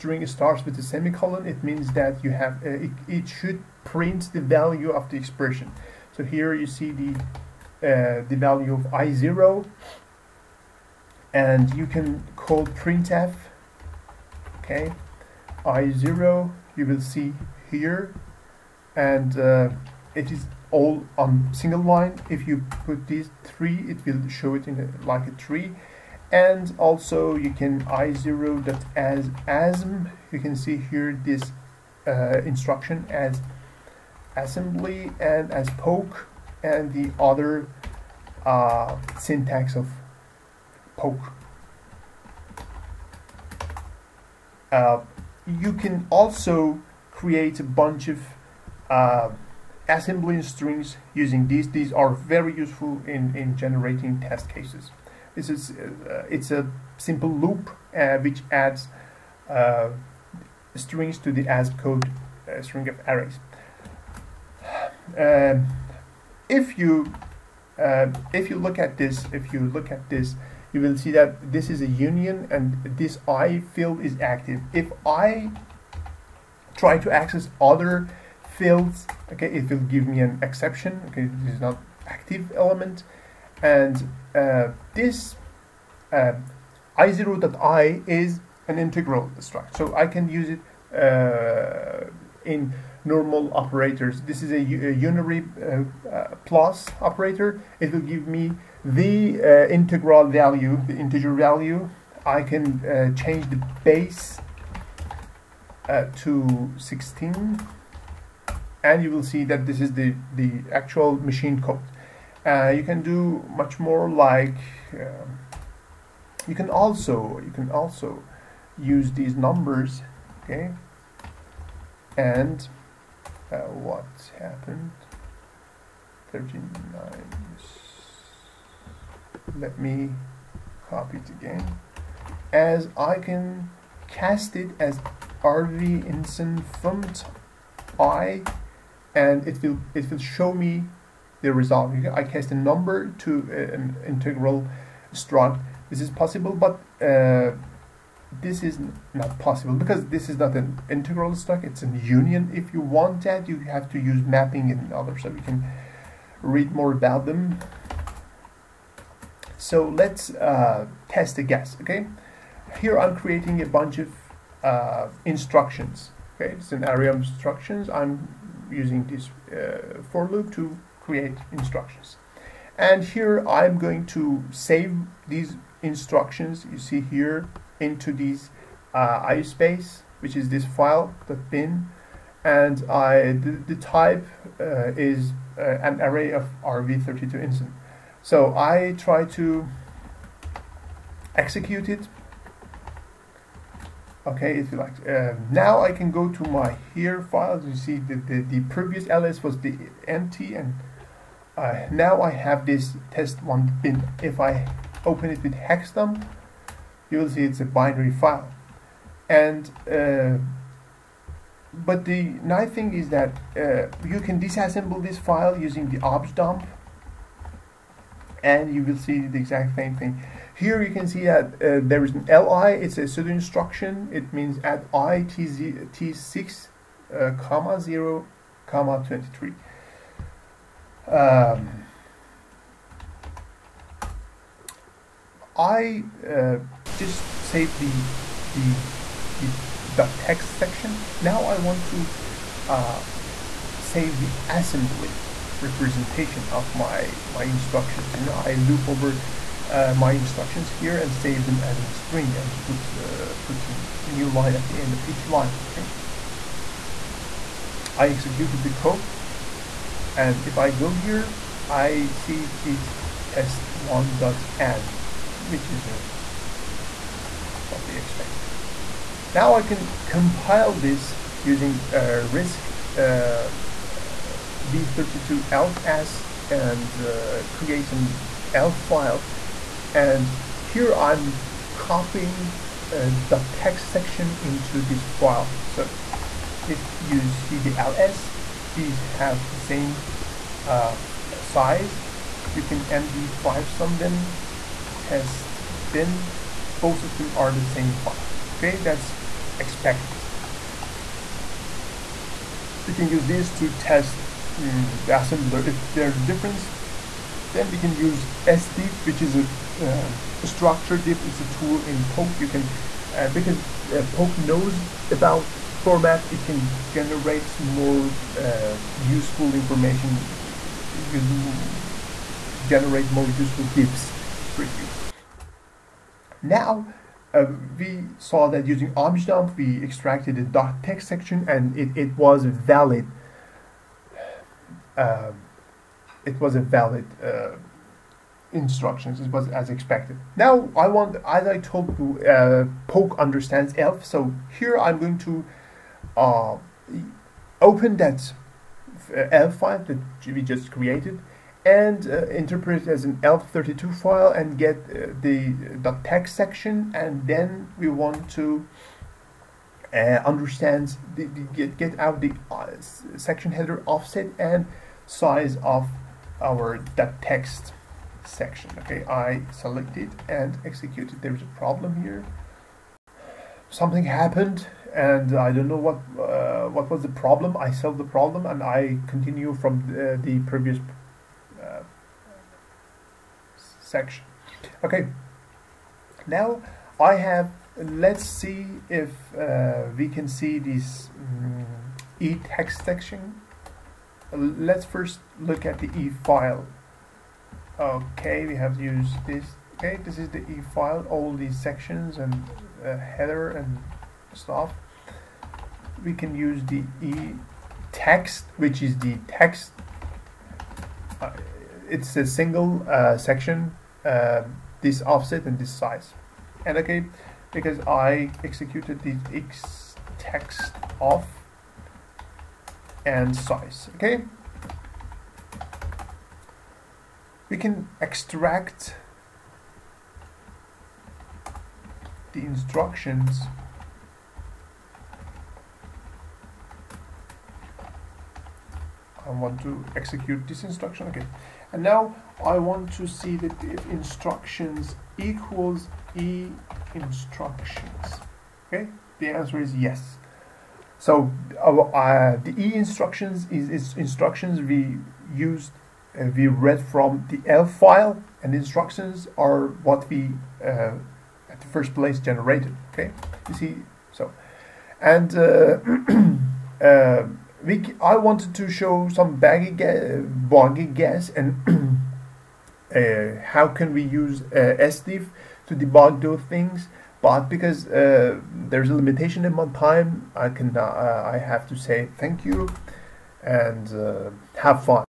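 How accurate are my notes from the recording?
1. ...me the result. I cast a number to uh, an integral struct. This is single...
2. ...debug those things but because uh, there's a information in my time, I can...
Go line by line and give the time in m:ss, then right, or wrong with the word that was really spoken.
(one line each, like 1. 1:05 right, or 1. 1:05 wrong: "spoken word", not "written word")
1. 2:20 wrong: "possible", not "single"
2. 7:55 wrong: "limitation", not "information".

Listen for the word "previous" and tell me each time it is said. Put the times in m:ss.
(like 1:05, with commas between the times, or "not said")
3:18, 6:20.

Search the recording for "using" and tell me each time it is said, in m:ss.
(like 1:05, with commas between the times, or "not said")
0:51, 2:48, 3:35, 4:31, 5:28.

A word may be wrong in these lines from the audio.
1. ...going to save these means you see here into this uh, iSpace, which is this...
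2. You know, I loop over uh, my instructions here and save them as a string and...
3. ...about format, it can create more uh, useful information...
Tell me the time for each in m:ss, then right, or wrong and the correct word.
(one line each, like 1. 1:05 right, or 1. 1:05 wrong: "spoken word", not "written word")
1. 2:53 wrong: "instructions", not "means"
2. 4:08 right
3. 5:15 wrong: "generate", not "create".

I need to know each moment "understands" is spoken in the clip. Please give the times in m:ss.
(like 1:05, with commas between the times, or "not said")
5:43, 6:00.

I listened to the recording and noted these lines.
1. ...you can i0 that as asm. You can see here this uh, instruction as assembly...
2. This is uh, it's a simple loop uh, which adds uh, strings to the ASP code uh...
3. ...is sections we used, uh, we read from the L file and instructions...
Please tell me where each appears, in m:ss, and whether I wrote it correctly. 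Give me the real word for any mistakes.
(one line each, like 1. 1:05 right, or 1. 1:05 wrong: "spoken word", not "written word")
1. 0:27 right
2. 0:55 right
3. 7:33 wrong: "instructions", not "sections".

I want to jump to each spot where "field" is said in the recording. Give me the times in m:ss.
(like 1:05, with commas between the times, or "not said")
1:13, 1:18.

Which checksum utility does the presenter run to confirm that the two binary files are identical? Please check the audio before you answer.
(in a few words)
md5sum.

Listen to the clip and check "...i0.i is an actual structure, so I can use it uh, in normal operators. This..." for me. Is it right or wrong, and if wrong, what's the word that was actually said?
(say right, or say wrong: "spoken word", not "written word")
wrong: "integral", not "actual".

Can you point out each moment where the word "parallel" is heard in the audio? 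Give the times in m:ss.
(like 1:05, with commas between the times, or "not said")
not said.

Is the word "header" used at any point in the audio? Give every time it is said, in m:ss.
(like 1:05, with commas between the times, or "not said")
6:03, 6:42.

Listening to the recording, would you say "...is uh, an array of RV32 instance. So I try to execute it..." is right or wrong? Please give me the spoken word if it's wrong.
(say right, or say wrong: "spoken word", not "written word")
right.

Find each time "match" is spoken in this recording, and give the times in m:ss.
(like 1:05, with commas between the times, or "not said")
not said.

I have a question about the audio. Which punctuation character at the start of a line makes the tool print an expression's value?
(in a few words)
semicolon.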